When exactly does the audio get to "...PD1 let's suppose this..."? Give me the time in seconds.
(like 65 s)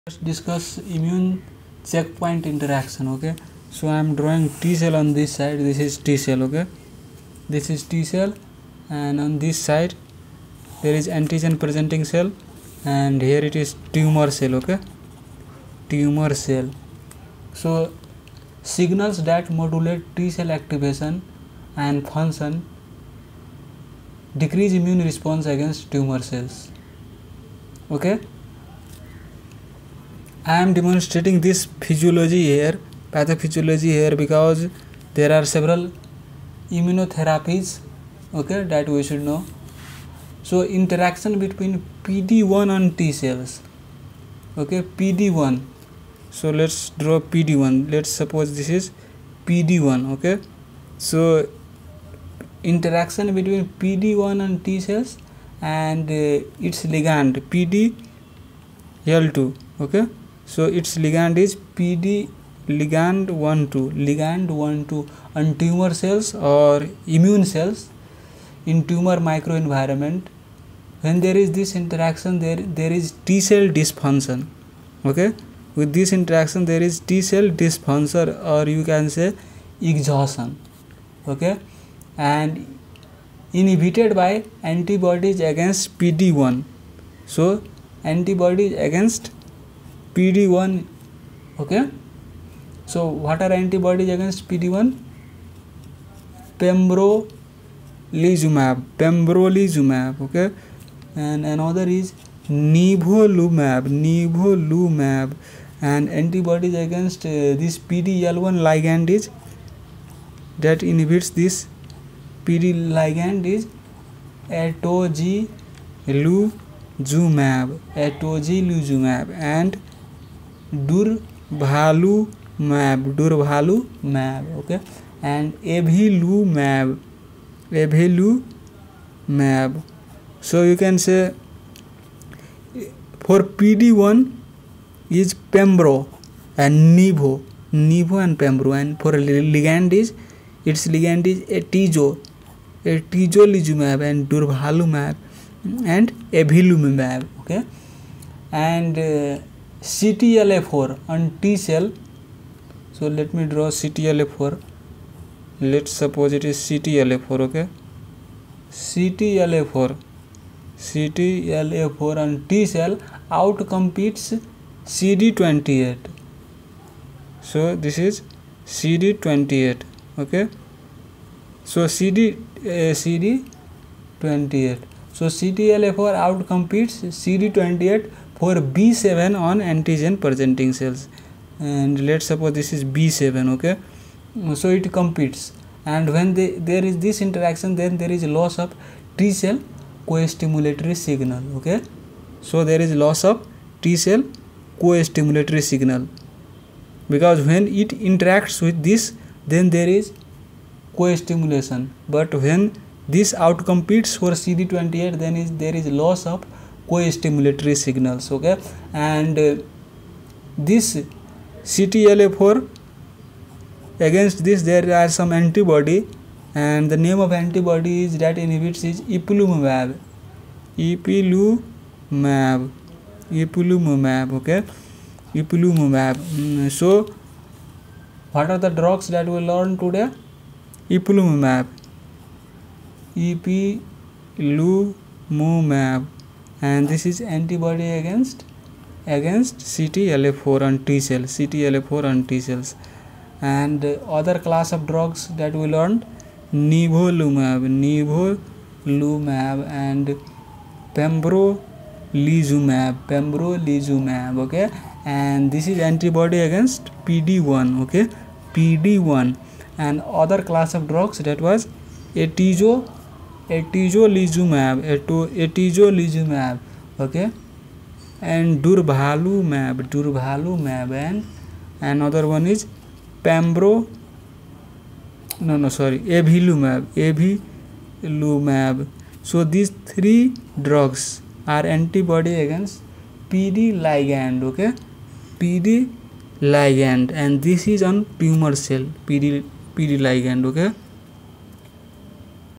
47 s.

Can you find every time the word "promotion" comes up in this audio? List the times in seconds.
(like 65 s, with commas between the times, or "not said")
not said.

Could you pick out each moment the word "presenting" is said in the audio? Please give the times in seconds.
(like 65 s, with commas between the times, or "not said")
11 s, 180 s.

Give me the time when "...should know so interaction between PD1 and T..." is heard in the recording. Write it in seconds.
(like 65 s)
39 s.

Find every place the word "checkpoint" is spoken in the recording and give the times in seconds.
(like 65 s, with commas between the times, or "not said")
1 s.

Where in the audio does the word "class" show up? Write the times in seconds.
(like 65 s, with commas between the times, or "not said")
244 s, 260 s.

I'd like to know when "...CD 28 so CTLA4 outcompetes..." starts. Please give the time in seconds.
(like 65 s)
172 s.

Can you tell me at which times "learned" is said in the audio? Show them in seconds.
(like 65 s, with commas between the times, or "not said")
245 s.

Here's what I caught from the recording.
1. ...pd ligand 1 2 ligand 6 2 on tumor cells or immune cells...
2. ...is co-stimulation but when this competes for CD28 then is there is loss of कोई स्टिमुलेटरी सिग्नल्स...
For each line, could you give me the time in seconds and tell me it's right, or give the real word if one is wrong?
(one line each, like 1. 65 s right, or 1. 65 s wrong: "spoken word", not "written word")
1. 61 s wrong: "1", not "6"
2. 199 s wrong: "outcompetes", not "competes".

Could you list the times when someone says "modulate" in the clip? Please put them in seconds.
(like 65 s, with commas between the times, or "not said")
19 s.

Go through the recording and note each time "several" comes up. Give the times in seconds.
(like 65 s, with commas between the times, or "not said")
35 s.